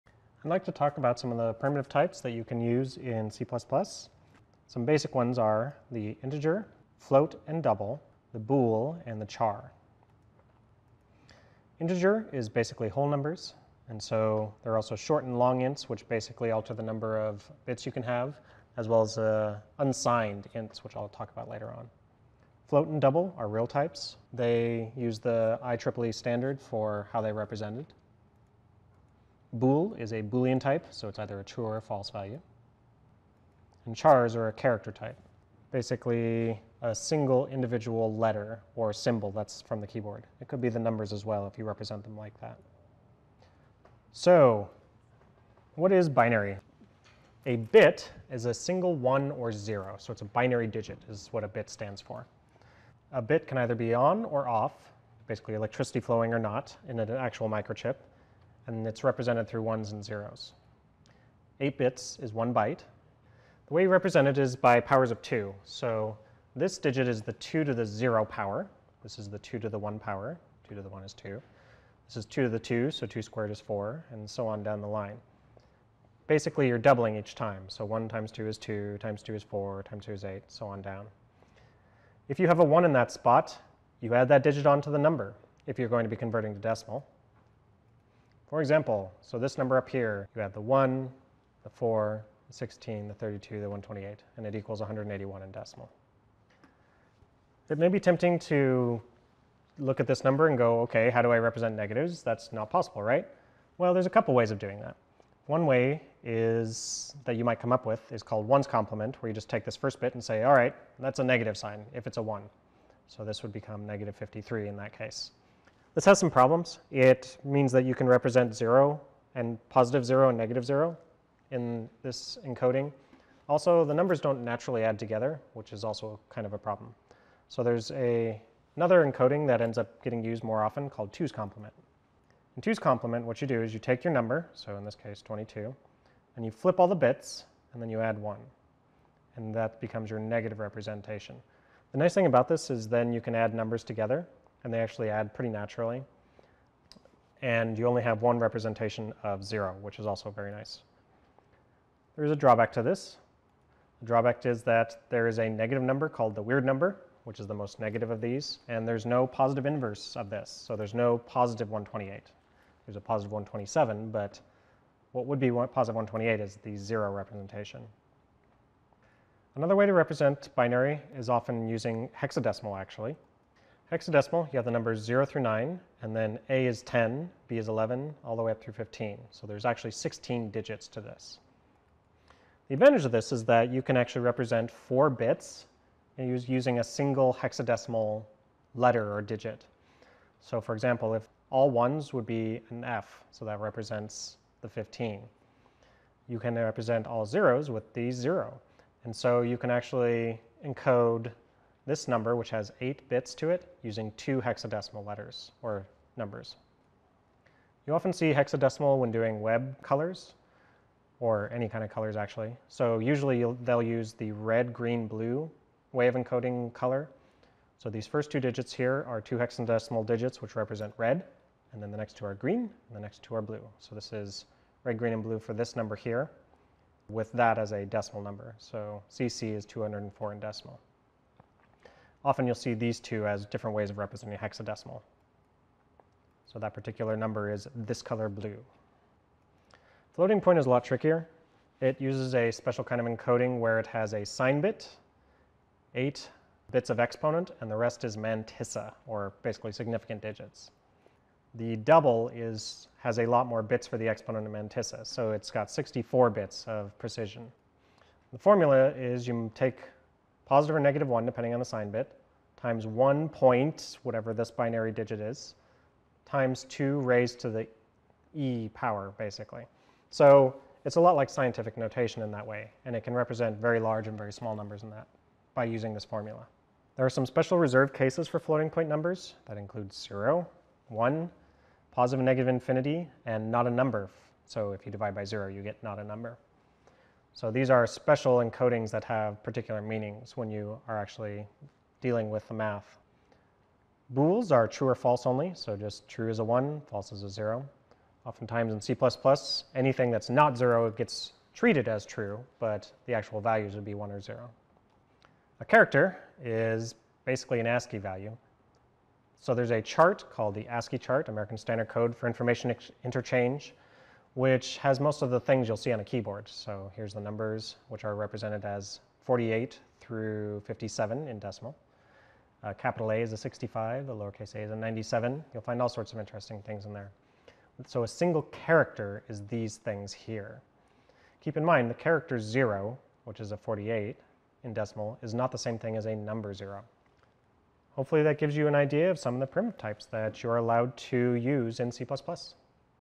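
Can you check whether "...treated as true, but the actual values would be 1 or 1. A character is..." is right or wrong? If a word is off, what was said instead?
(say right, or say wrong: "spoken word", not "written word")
wrong: "0", not "1".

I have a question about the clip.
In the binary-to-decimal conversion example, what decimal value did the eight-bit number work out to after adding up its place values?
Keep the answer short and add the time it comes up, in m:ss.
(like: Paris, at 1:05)
181, at 1:34.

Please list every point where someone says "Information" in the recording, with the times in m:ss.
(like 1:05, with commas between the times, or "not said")
5:12.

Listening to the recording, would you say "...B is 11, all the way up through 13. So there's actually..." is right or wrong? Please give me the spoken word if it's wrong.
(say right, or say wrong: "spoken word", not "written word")
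wrong: "15", not "13".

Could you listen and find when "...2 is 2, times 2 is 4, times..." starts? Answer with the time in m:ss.
1:18.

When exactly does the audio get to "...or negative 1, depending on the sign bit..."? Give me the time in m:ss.
4:20.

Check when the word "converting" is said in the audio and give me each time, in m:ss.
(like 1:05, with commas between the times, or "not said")
1:26.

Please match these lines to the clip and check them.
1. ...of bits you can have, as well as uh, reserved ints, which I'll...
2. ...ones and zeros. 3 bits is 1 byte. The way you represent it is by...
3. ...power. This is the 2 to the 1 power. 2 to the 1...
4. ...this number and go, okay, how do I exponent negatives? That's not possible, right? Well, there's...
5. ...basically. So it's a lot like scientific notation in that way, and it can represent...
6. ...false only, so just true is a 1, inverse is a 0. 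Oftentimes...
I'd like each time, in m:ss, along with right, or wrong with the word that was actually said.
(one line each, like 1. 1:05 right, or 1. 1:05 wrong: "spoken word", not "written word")
1. 0:17 wrong: "unsigned", not "reserved"
2. 0:59 wrong: "8", not "3"
3. 1:08 right
4. 1:40 wrong: "represent", not "exponent"
5. 4:29 right
6. 4:54 wrong: "false", not "inverse".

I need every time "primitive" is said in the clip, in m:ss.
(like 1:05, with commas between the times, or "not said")
0:01, 5:39.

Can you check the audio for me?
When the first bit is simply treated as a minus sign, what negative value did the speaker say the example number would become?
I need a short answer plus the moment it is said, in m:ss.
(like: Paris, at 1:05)
-53, at 1:53.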